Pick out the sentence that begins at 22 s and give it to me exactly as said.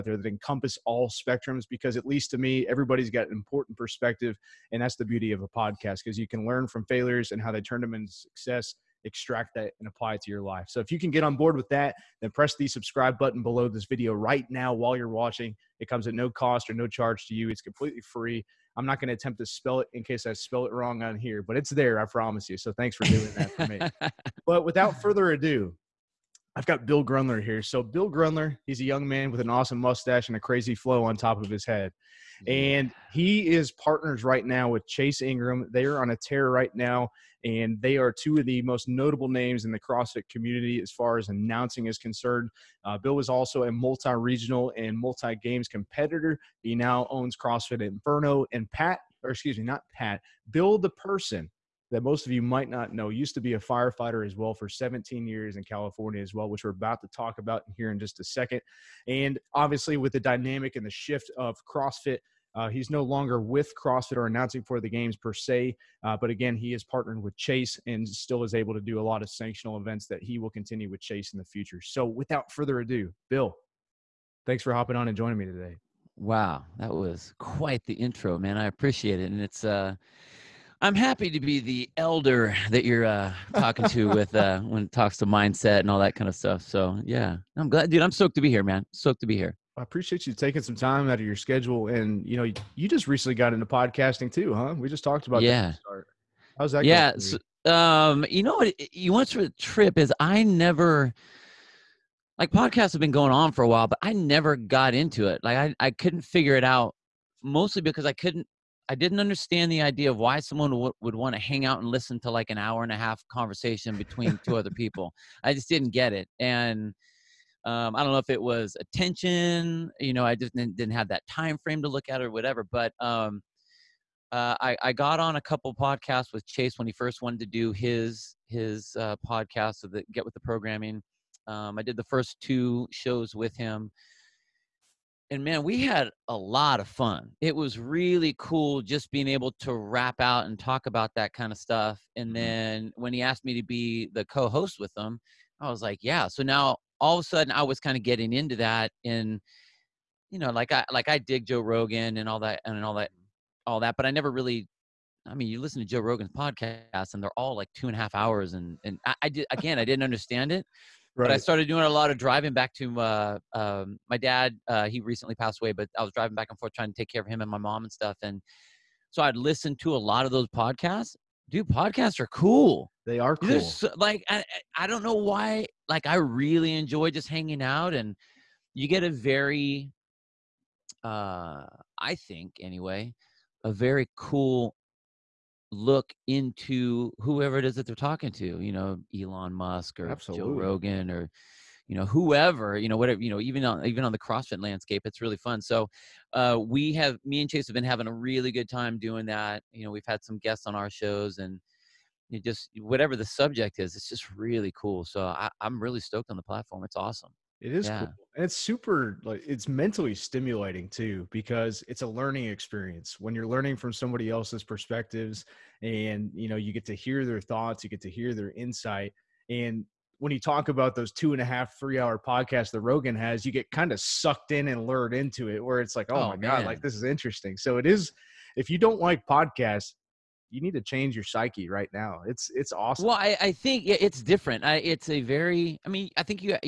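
So thanks for doing that for me.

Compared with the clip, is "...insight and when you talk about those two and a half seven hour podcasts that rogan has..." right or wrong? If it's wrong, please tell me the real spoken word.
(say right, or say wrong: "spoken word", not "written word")
wrong: "three", not "seven".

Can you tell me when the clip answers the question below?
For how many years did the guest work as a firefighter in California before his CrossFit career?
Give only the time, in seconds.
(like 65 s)
54 s.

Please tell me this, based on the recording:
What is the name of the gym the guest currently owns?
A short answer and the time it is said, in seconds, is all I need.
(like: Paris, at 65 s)
CrossFit Inferno, at 47 s.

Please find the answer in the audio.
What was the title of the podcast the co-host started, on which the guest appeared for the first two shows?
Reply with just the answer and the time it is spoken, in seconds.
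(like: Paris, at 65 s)
Get with the Programming, at 130 s.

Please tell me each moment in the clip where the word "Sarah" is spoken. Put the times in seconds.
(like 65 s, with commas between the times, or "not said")
not said.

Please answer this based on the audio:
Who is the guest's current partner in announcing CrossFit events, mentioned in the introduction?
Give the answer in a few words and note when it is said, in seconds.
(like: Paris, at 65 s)
Chase Ingram, at 34 s.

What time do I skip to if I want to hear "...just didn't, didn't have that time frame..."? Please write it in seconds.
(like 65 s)
120 s.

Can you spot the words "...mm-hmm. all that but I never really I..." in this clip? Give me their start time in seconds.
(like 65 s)
153 s.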